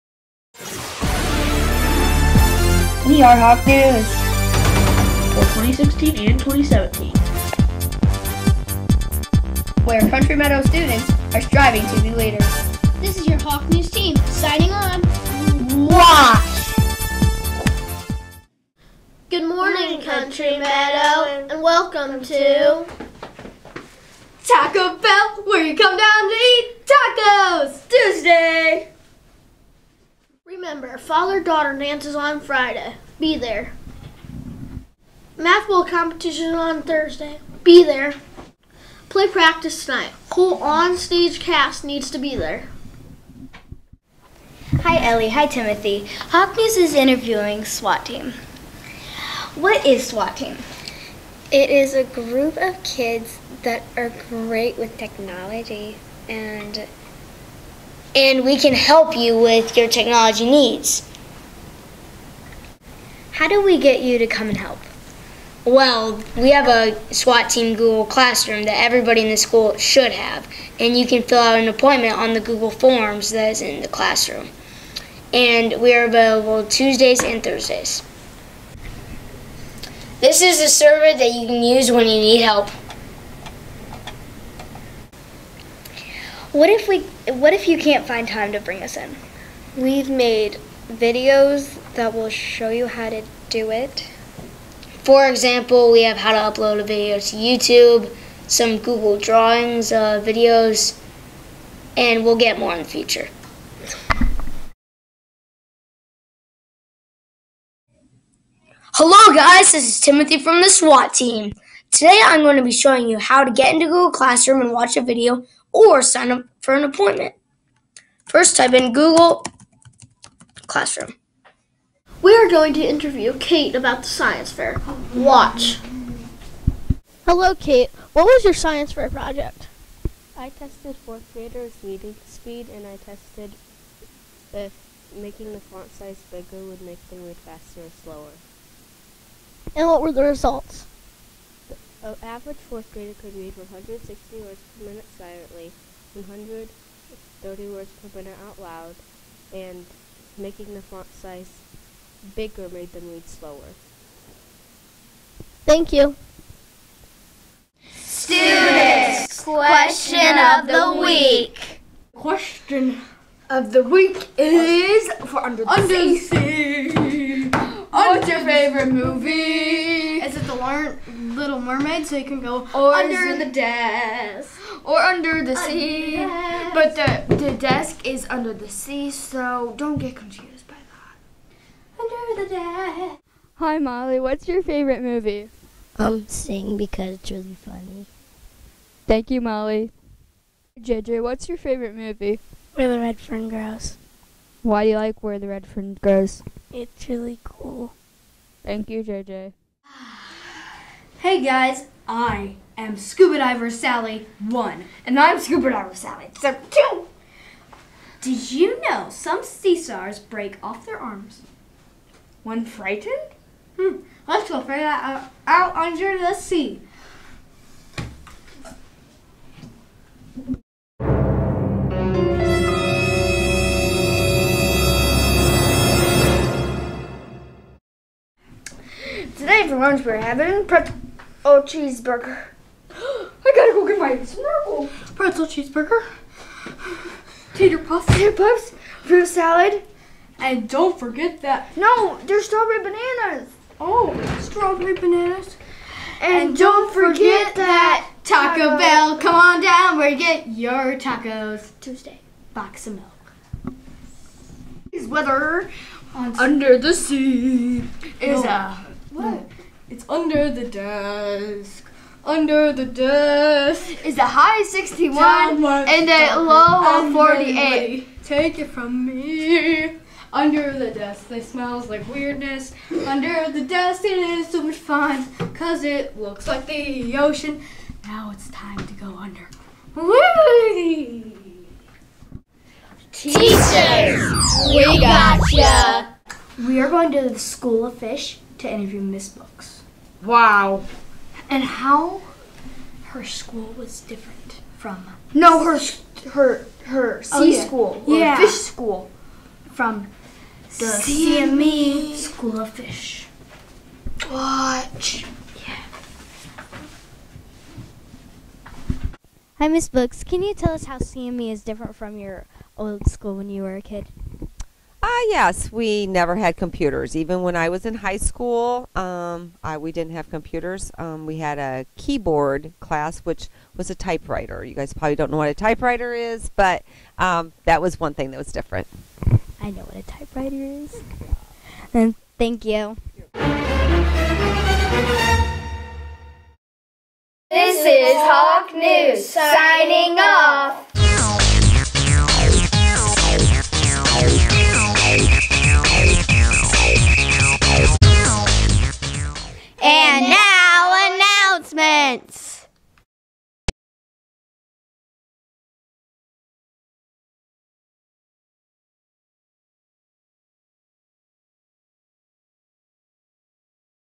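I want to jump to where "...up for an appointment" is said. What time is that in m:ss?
1:56.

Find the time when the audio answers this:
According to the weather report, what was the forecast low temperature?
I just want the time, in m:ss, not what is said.
4:27.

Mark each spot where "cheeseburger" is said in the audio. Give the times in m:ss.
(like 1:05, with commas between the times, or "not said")
3:51, 3:55.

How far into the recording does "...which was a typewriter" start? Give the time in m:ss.
5:23.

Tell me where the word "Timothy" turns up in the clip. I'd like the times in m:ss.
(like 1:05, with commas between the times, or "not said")
0:45, 1:50.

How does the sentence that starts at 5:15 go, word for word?
Ah, yes, we never had computers.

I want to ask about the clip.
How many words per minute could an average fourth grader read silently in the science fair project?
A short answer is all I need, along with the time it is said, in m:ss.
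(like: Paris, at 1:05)
160, at 2:23.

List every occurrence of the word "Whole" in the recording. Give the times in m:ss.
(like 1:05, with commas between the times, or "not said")
0:40.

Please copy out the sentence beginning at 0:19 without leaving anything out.
Good morning, Country Meadow, and welcome to Taco Bell, where you come down to eat tacos!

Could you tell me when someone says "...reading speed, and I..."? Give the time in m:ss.
2:11.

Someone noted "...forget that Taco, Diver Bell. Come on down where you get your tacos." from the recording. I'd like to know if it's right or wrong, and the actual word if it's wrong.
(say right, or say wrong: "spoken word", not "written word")
wrong: "Taco", not "Diver".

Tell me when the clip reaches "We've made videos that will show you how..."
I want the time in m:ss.
1:29.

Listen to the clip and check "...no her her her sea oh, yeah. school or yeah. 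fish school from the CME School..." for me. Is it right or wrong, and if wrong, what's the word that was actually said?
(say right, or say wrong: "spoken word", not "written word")
right.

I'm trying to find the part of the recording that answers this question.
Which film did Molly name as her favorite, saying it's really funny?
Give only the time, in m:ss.
3:06.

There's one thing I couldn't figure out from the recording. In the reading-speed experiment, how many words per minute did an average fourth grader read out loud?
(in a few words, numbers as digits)
130.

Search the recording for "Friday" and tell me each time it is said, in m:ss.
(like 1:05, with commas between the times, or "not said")
0:32.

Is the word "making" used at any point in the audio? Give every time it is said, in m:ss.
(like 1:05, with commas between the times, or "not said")
2:15, 2:30.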